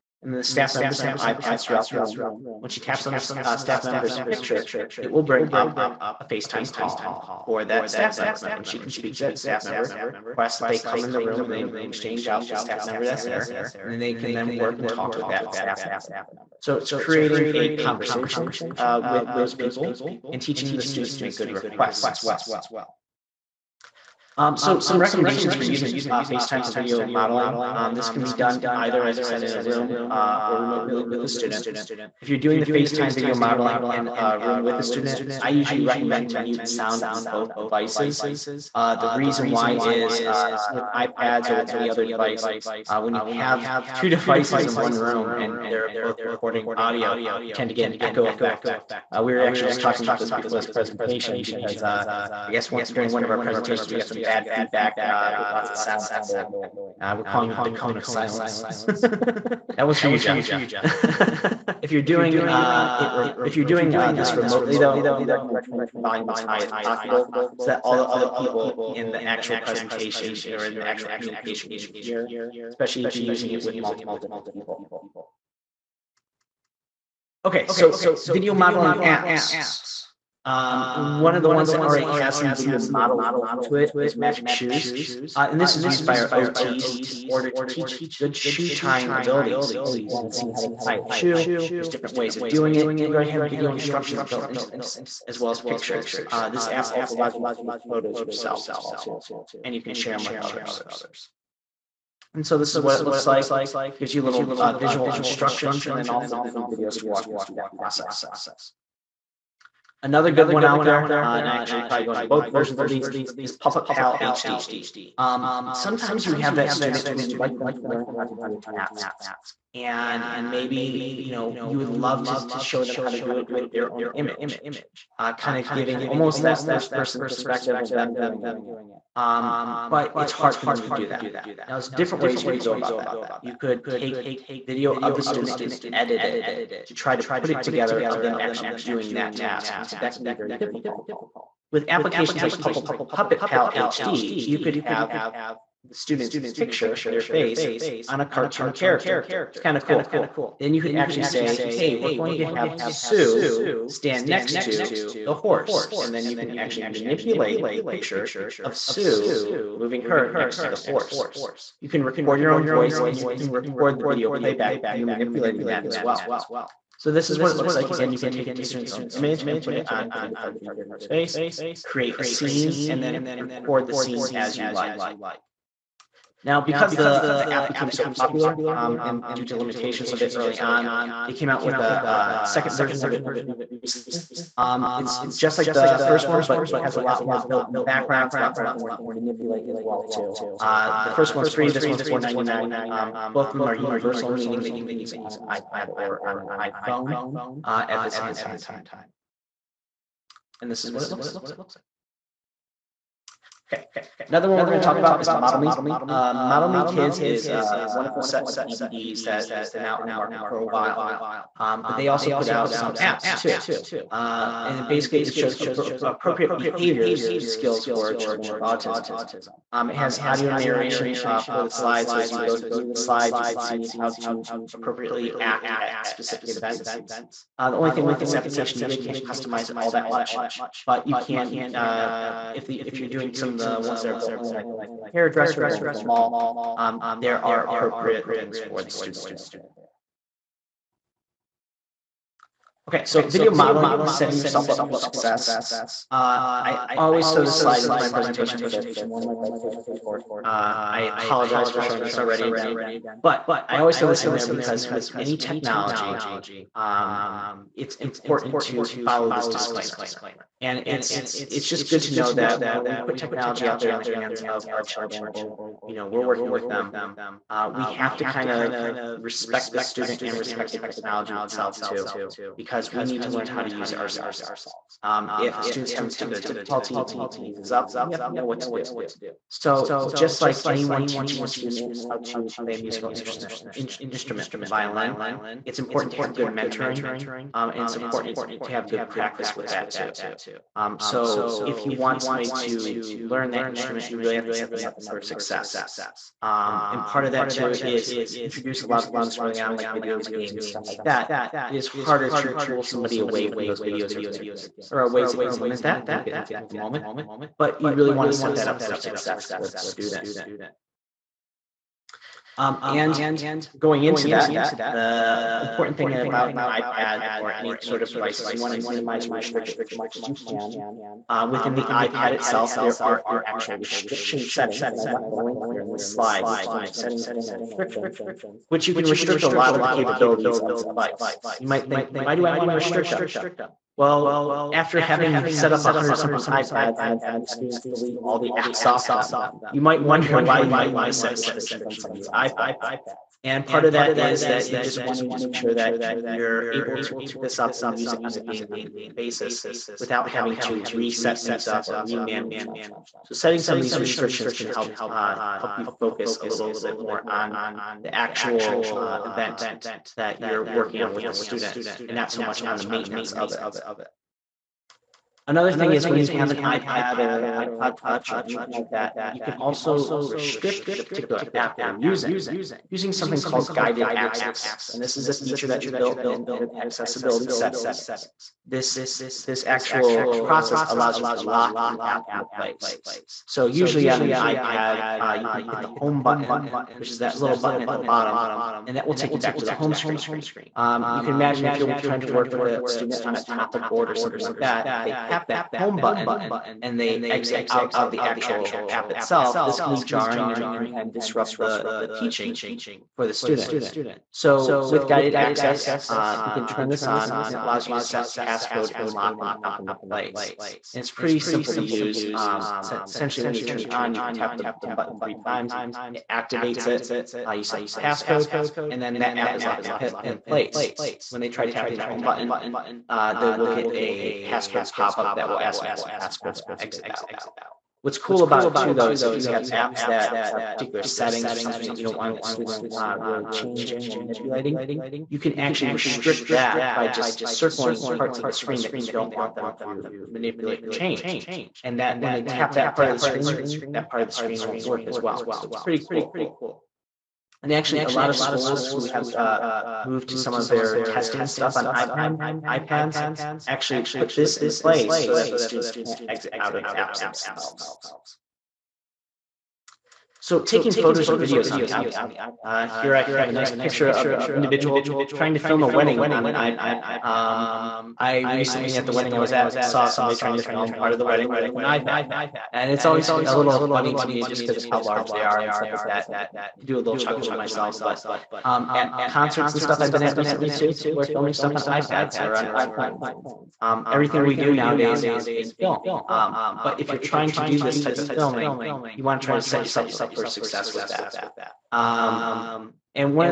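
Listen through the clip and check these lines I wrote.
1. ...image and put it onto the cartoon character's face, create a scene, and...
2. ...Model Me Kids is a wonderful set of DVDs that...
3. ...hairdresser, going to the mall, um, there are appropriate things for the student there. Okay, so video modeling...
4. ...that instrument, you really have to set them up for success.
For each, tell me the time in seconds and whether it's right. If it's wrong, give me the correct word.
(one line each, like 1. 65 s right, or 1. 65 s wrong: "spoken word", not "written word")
1. 169 s right
2. 206 s right
3. 235 s right
4. 293 s right.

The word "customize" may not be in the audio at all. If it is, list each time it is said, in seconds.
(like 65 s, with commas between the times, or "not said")
229 s.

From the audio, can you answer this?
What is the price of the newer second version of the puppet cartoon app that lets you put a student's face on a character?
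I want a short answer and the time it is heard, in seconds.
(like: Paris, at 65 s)
$4.99, at 192 s.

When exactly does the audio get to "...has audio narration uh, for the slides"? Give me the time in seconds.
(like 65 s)
219 s.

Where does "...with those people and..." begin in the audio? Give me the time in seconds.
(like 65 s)
19 s.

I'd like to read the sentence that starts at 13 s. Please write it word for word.
And then they can then work and talk with that staff member.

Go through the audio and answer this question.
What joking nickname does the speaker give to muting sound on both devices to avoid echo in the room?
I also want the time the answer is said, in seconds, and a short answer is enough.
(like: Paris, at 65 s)
the cone of silence, at 57 s.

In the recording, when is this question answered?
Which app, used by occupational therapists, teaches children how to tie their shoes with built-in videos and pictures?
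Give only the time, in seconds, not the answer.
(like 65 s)
84 s.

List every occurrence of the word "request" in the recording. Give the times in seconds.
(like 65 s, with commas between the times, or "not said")
10 s, 21 s.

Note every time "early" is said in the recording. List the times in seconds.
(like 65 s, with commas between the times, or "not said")
180 s, 299 s.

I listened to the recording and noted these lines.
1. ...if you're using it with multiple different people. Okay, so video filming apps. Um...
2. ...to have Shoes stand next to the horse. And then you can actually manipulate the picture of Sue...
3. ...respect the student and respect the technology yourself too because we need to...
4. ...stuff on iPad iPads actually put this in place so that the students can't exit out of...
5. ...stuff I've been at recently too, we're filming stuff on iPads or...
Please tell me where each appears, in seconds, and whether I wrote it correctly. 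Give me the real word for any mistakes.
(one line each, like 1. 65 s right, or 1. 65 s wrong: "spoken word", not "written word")
1. 73 s wrong: "modeling", not "filming"
2. 152 s wrong: "Sue", not "Shoes"
3. 269 s wrong: "itself", not "yourself"
4. 451 s right
5. 479 s right.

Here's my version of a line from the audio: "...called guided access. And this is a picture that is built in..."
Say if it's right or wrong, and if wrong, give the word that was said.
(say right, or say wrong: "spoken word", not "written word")
wrong: "feature", not "picture".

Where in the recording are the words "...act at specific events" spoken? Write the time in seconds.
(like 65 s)
225 s.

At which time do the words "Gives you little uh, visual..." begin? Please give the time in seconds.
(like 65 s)
103 s.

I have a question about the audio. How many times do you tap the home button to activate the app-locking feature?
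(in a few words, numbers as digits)
3.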